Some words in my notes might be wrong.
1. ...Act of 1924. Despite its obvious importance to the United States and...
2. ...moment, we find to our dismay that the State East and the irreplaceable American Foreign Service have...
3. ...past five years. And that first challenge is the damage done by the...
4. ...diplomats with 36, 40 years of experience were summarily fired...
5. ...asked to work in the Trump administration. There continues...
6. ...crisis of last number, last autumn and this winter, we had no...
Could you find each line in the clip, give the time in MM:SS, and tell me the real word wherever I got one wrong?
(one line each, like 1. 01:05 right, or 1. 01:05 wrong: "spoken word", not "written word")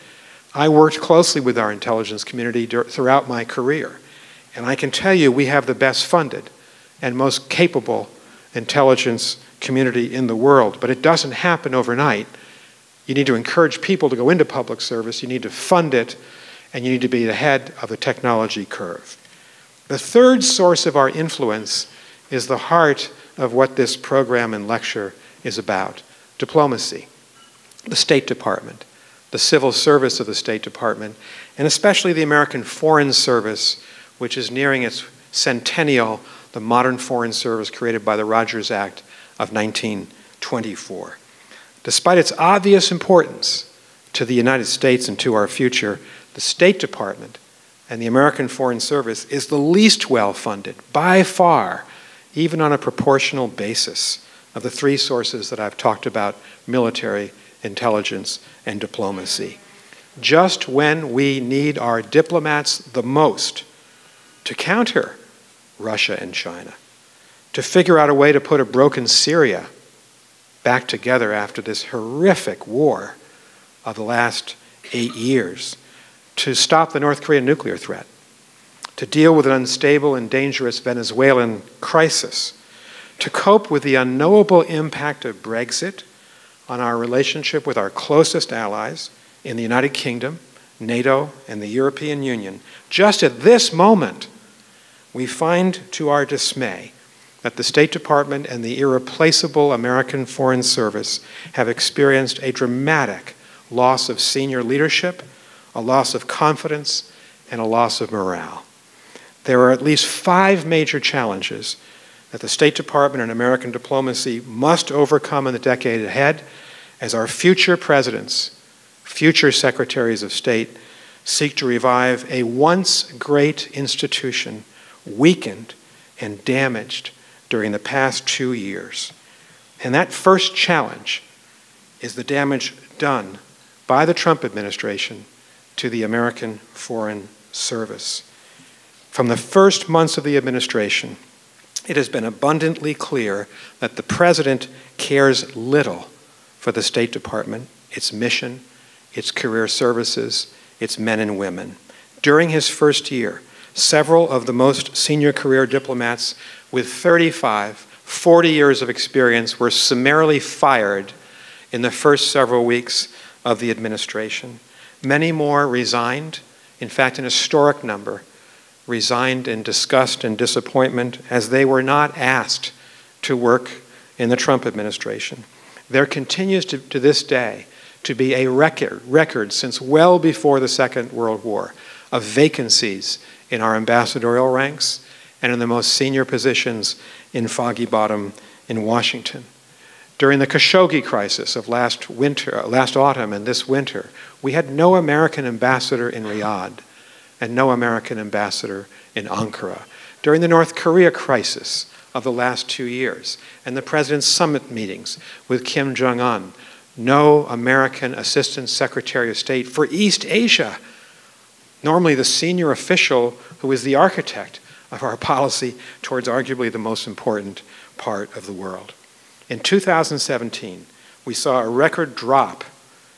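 1. 00:38 right
2. 01:33 wrong: "Department", not "East"
3. 02:07 wrong: "two", not "five"
4. 02:35 wrong: "35", not "36"
5. 02:52 right
6. 03:11 wrong: "winter", not "number".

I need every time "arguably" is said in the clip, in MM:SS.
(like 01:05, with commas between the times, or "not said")
03:36.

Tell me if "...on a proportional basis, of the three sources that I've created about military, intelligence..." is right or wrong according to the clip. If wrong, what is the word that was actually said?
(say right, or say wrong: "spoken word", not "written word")
wrong: "talked", not "created".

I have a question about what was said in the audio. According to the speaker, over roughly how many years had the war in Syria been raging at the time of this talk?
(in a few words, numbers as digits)
8.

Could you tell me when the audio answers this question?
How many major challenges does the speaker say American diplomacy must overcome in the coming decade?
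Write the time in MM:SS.
01:50.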